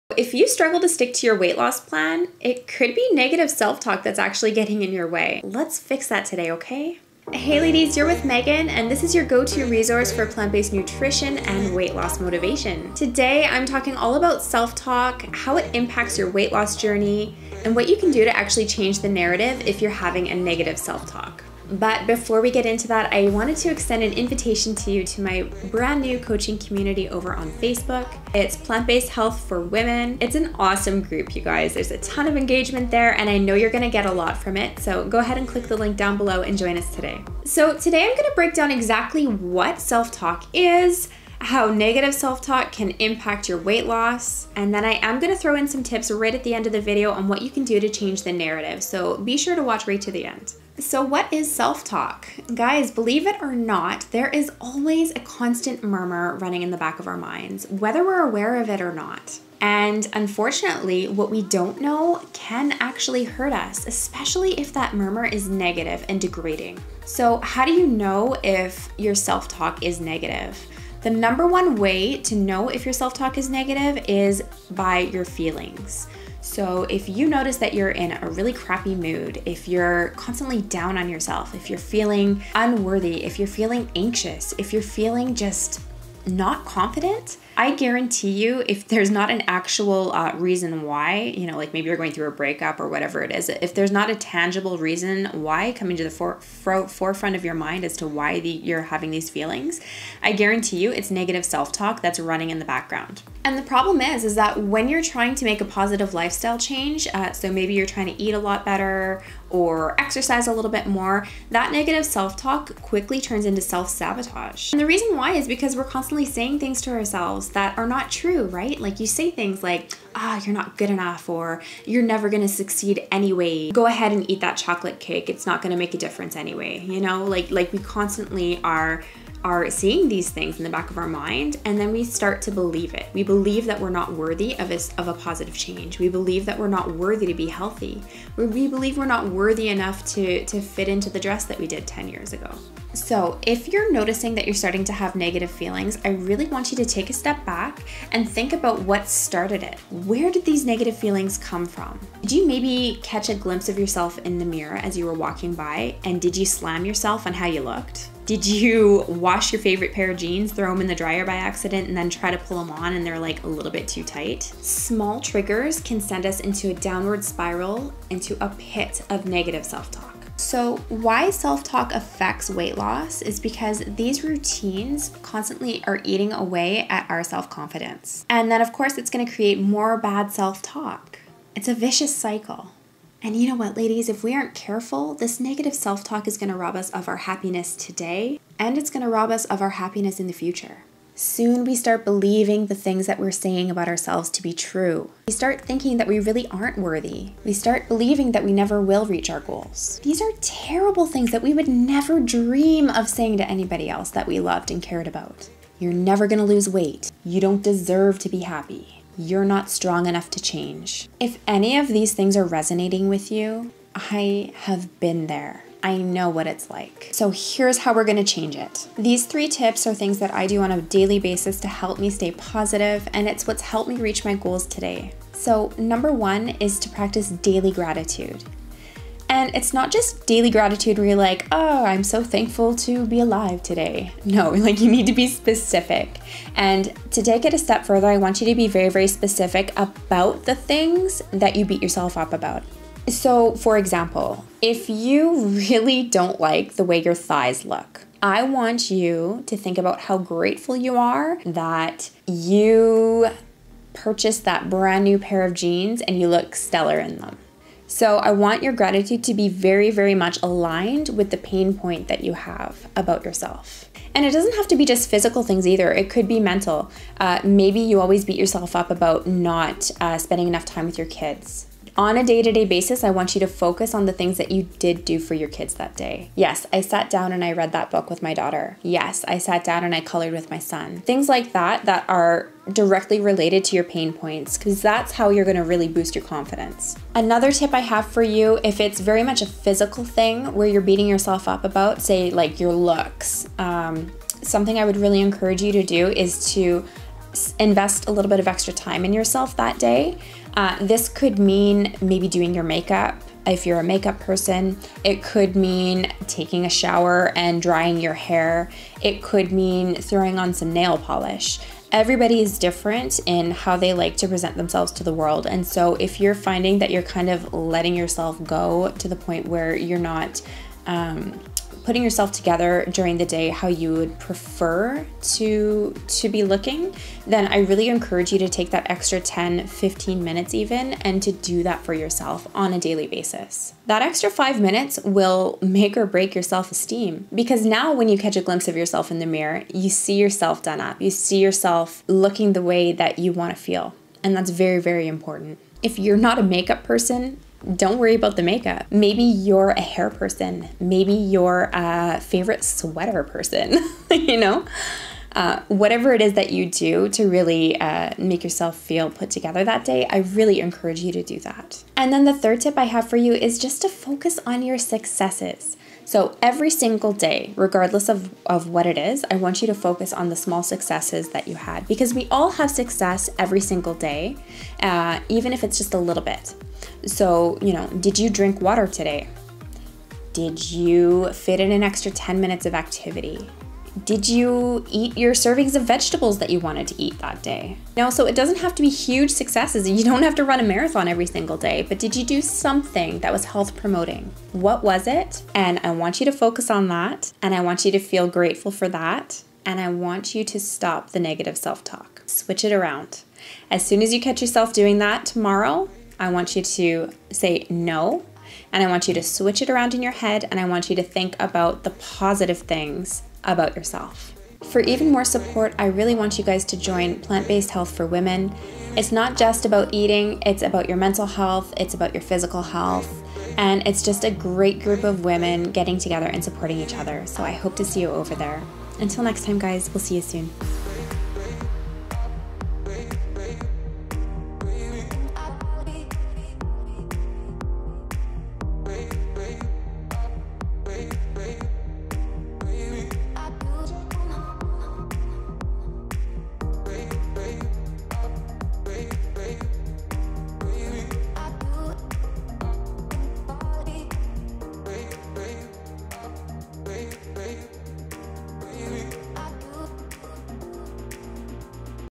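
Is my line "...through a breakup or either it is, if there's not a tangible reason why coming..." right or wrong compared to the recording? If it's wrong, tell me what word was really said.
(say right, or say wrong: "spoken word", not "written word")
wrong: "whatever", not "either".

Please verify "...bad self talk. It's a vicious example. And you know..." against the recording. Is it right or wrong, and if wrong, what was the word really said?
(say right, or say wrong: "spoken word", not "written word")
wrong: "cycle", not "example".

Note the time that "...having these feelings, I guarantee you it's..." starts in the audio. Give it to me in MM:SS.
01:38.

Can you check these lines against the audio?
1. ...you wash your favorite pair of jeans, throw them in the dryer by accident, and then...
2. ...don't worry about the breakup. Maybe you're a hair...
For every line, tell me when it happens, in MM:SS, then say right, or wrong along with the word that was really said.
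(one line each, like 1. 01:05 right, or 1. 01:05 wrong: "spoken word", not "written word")
1. 02:38 right
2. 05:47 wrong: "makeup", not "breakup".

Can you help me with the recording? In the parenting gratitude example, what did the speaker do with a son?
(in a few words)
Colored.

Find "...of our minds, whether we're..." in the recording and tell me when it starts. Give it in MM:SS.
00:56.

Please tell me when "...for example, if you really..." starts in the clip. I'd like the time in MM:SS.
04:03.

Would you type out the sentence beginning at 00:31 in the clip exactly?
There's a ton of engagement there, and I know you're gonna get a lot from it.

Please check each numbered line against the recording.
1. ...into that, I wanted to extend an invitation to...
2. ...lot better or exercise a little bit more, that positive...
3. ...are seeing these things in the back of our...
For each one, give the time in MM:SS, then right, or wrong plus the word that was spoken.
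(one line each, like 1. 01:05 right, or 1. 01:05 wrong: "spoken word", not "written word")
1. 00:22 right
2. 01:48 wrong: "negative", not "positive"
3. 02:09 right.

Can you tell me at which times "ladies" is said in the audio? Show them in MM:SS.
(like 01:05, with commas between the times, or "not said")
00:07, 03:03.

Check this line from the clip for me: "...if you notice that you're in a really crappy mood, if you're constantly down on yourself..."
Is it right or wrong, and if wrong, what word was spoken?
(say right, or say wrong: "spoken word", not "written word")
right.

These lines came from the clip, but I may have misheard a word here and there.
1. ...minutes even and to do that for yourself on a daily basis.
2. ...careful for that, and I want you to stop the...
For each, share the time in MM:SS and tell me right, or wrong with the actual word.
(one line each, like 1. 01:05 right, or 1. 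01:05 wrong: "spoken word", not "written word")
1. 05:30 right
2. 06:38 wrong: "grateful", not "careful".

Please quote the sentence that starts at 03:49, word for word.
And it's not just daily gratitude where you're like, oh, I'm so thankful to be alive today.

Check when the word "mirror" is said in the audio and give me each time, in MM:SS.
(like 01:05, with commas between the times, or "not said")
02:34, 05:39.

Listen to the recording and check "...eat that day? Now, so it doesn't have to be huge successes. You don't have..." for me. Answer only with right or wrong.
right.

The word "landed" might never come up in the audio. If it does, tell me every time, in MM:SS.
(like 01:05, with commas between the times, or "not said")
not said.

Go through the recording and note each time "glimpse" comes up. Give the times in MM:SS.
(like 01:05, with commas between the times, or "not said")
02:33, 05:38.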